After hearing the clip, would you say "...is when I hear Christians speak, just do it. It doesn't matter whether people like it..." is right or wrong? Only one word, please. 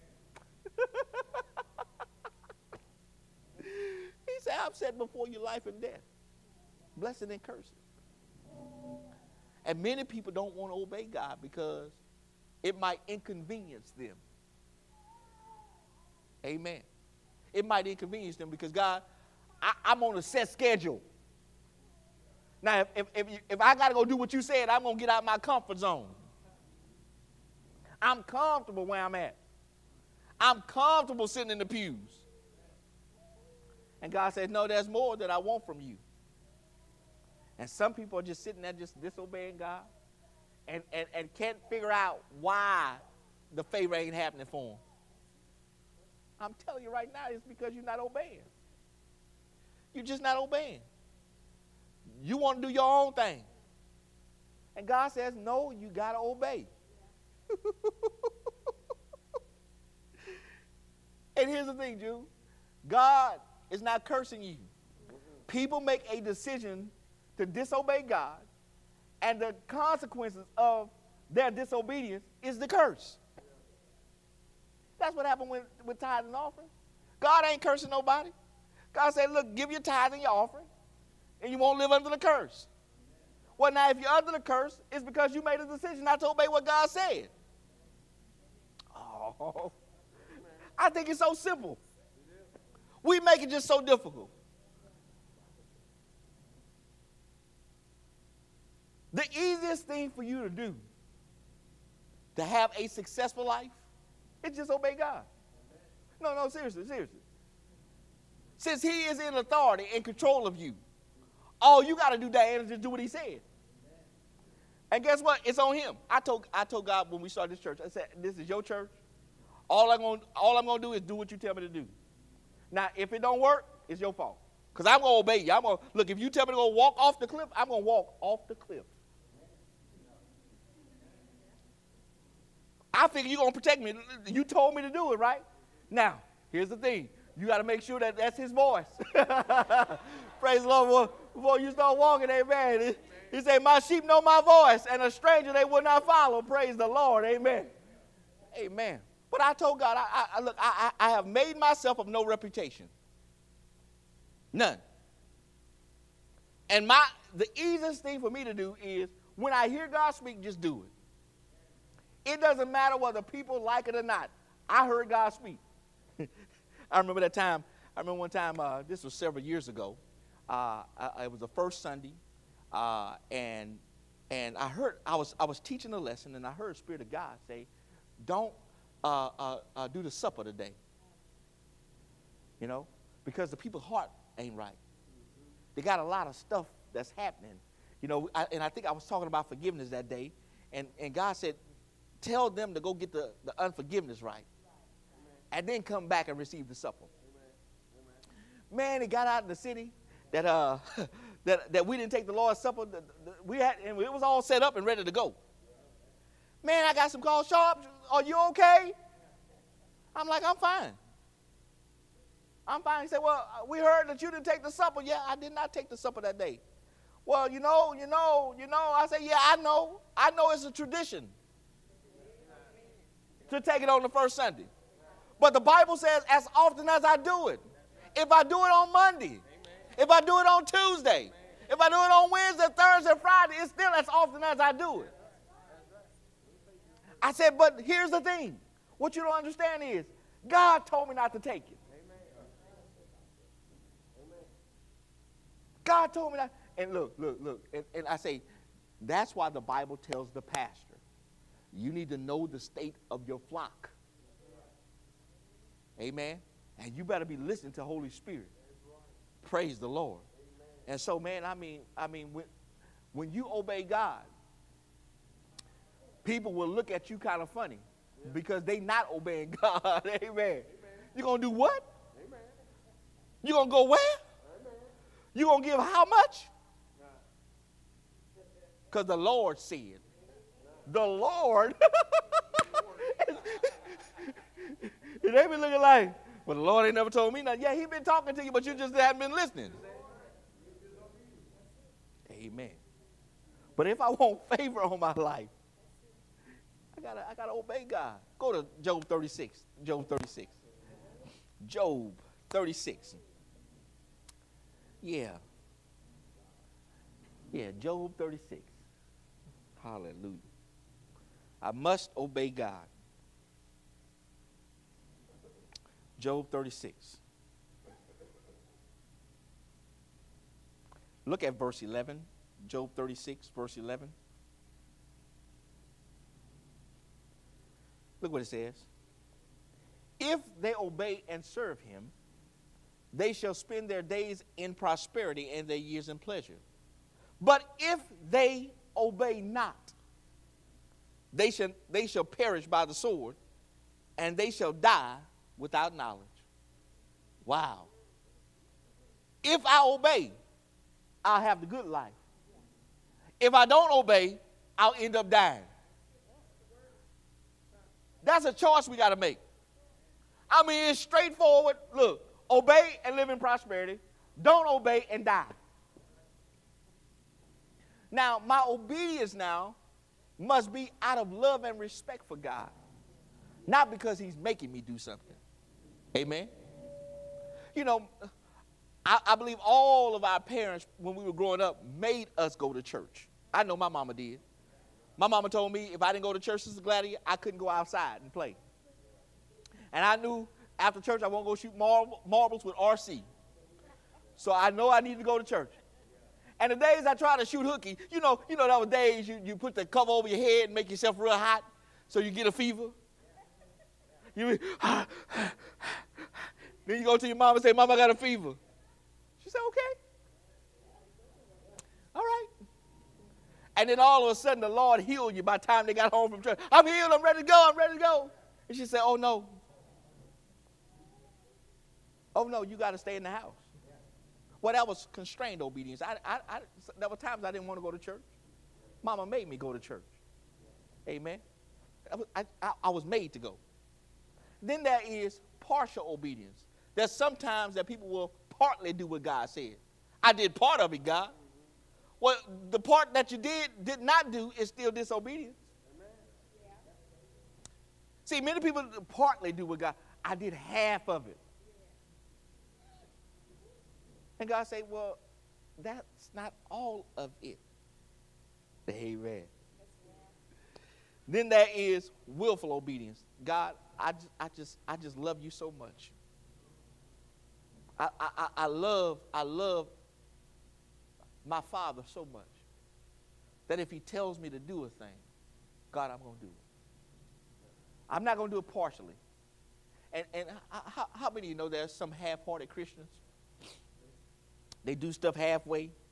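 wrong.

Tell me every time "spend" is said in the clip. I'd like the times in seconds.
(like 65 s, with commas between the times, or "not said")
333 s.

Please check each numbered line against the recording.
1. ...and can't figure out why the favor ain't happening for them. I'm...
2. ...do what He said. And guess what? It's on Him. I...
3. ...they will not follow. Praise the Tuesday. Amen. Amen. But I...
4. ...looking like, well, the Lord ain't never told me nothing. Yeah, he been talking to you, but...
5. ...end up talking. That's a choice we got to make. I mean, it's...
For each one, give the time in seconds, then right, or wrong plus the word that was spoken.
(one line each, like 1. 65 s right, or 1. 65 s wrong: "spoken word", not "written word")
1. 41 s right
2. 112 s right
3. 145 s wrong: "Lord", not "Tuesday"
4. 285 s right
5. 354 s wrong: "dying", not "talking".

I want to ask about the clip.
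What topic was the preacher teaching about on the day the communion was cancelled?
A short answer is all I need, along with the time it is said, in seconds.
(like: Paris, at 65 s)
Forgiveness, at 189 s.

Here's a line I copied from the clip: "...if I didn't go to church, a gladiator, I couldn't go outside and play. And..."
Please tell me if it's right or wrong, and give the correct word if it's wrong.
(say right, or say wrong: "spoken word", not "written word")
right.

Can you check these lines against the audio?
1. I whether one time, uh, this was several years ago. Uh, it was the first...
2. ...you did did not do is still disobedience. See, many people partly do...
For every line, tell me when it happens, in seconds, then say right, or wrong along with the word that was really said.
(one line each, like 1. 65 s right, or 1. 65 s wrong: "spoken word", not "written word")
1. 167 s wrong: "remember", not "whether"
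2. 443 s right.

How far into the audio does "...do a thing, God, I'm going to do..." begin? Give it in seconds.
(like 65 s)
474 s.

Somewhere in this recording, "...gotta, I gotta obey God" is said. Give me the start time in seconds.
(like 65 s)
297 s.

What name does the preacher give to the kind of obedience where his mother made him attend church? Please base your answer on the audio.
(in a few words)
constrained obedience.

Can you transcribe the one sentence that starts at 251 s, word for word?
You need to know the state of your flock.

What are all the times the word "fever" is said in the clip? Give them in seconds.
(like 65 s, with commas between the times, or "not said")
402 s, 408 s.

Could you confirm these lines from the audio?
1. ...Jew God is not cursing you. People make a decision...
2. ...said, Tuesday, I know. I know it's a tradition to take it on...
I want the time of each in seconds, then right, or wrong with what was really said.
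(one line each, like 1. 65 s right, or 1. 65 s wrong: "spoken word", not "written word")
1. 61 s right
2. 219 s wrong: "Yeah", not "Tuesday".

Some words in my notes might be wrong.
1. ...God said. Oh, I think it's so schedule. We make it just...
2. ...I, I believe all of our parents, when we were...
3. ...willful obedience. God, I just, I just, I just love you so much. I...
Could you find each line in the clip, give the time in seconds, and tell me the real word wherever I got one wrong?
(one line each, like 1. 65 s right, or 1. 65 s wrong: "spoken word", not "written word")
1. 86 s wrong: "simple", not "schedule"
2. 379 s right
3. 462 s right.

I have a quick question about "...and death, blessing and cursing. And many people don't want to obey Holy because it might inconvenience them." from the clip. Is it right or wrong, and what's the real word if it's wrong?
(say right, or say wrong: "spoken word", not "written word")
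wrong: "God", not "Holy".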